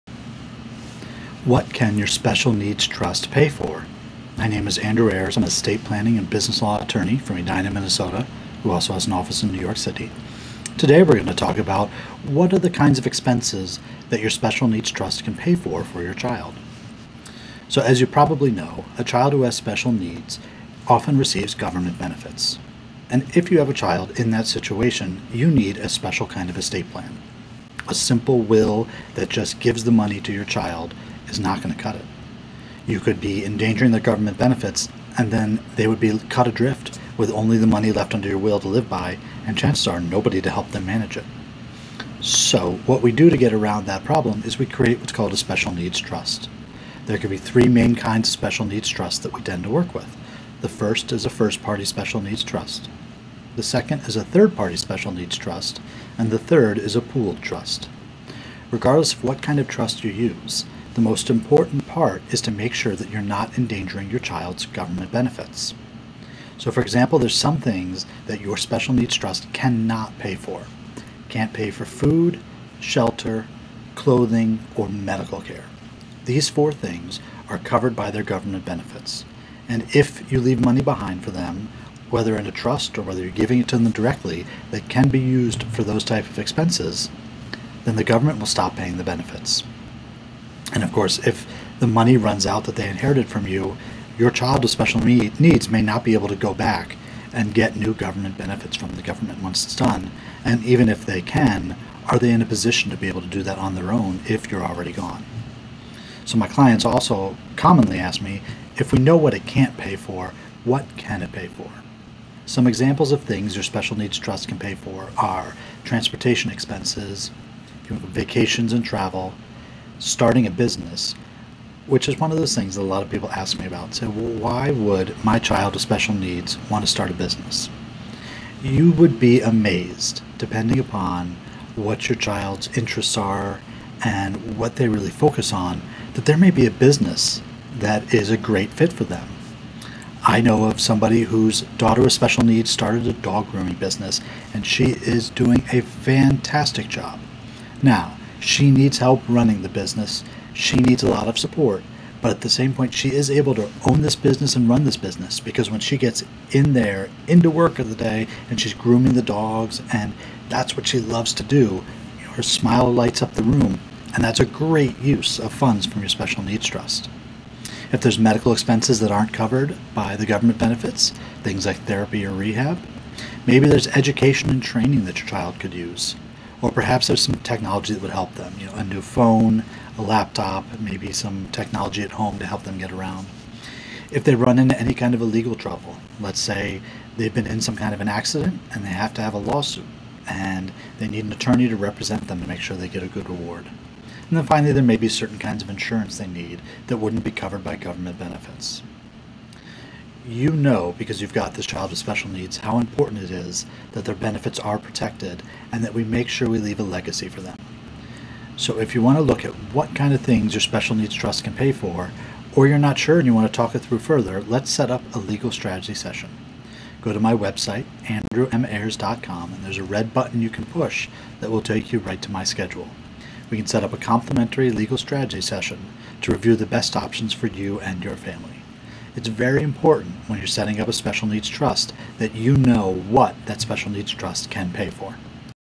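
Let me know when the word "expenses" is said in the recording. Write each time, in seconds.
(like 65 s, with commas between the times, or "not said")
13 s, 86 s, 116 s, 168 s.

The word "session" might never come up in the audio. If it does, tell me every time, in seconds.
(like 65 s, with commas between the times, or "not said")
215 s, 225 s.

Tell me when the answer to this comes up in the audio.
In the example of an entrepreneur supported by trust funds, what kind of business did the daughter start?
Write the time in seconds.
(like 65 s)
143 s.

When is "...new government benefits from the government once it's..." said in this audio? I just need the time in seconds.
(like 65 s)
97 s.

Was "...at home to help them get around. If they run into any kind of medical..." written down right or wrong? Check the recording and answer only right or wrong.
wrong.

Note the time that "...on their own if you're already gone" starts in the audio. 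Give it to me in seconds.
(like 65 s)
103 s.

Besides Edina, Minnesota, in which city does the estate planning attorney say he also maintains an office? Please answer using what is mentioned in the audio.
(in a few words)
New York City.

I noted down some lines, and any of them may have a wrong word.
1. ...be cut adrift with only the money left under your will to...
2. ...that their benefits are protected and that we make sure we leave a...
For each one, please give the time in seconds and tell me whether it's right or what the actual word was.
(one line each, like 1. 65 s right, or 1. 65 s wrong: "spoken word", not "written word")
1. 35 s right
2. 203 s right.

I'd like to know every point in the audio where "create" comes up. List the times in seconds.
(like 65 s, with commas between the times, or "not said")
44 s.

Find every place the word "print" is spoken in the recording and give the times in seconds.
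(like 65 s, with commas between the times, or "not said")
not said.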